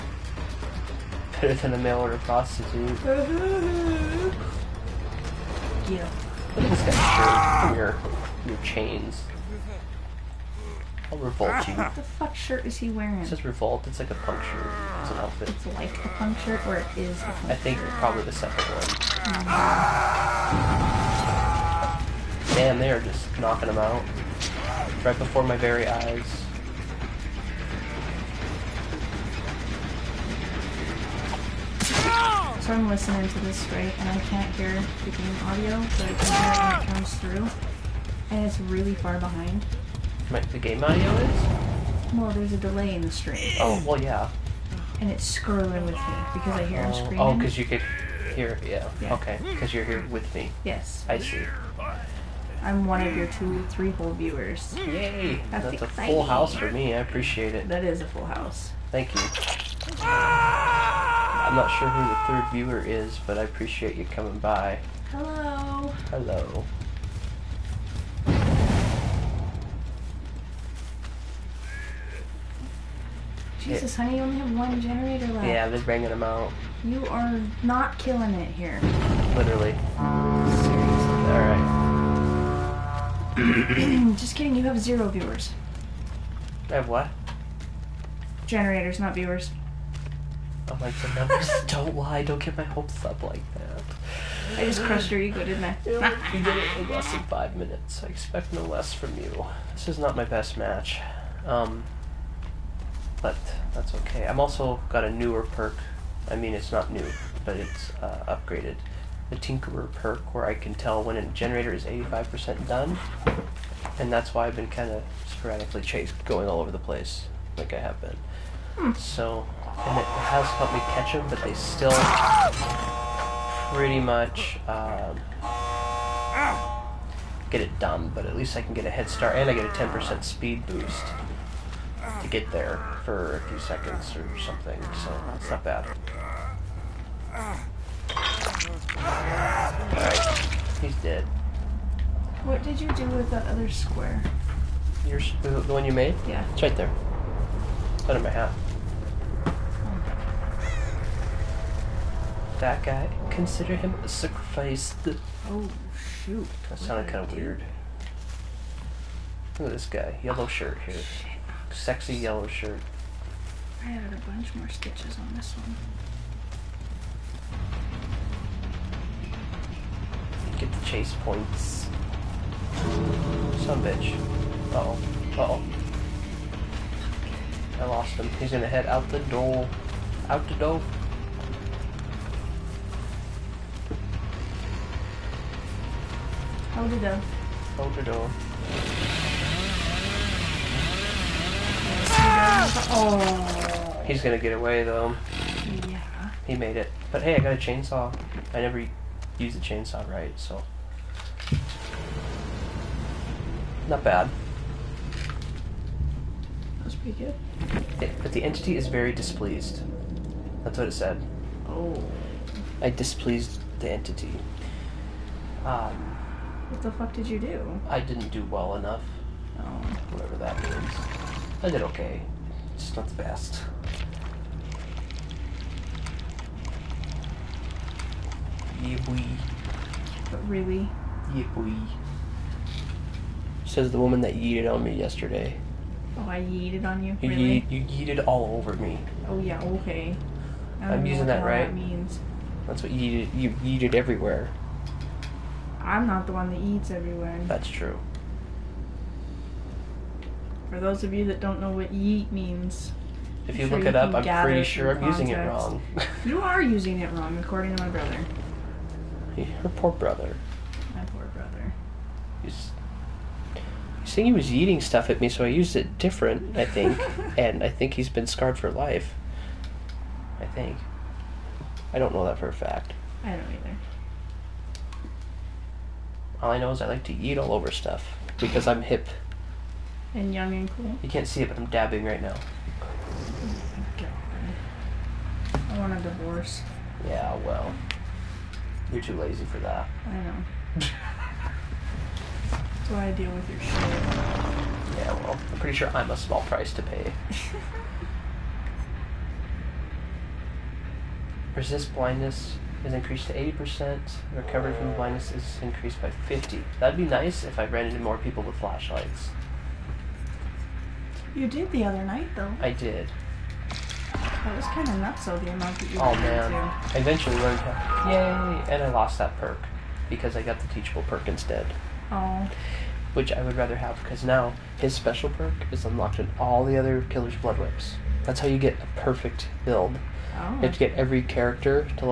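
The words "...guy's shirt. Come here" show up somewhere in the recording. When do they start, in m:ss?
0:06.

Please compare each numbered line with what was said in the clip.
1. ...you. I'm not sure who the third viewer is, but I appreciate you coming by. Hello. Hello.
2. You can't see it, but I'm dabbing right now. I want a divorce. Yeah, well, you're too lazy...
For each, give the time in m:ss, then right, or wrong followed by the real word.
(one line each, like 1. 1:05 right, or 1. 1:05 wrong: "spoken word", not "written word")
1. 0:59 right
2. 4:41 right.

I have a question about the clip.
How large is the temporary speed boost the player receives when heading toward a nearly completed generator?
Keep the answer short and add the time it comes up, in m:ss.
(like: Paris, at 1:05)
10%, at 2:09.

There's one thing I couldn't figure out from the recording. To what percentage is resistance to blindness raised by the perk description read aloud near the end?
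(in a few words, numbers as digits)
80%.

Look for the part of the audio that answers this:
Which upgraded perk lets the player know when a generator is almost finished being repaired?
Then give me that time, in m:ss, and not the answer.
1:49.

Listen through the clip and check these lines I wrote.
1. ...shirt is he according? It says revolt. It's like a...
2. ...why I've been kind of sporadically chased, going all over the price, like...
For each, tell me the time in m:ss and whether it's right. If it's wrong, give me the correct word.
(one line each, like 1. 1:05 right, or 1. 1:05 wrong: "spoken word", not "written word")
1. 0:12 wrong: "wearing", not "according"
2. 1:54 wrong: "place", not "price".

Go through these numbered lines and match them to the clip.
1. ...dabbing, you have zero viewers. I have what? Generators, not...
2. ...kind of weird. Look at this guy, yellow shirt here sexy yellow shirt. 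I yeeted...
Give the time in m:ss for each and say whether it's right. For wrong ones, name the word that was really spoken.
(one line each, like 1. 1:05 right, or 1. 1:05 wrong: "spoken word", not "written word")
1. 1:24 wrong: "kidding", not "dabbing"
2. 2:37 wrong: "added", not "yeeted".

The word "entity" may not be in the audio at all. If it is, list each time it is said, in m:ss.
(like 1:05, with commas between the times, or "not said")
3:28, 3:33.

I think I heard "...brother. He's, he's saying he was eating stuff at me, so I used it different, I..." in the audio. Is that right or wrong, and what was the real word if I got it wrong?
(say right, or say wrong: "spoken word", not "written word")
right.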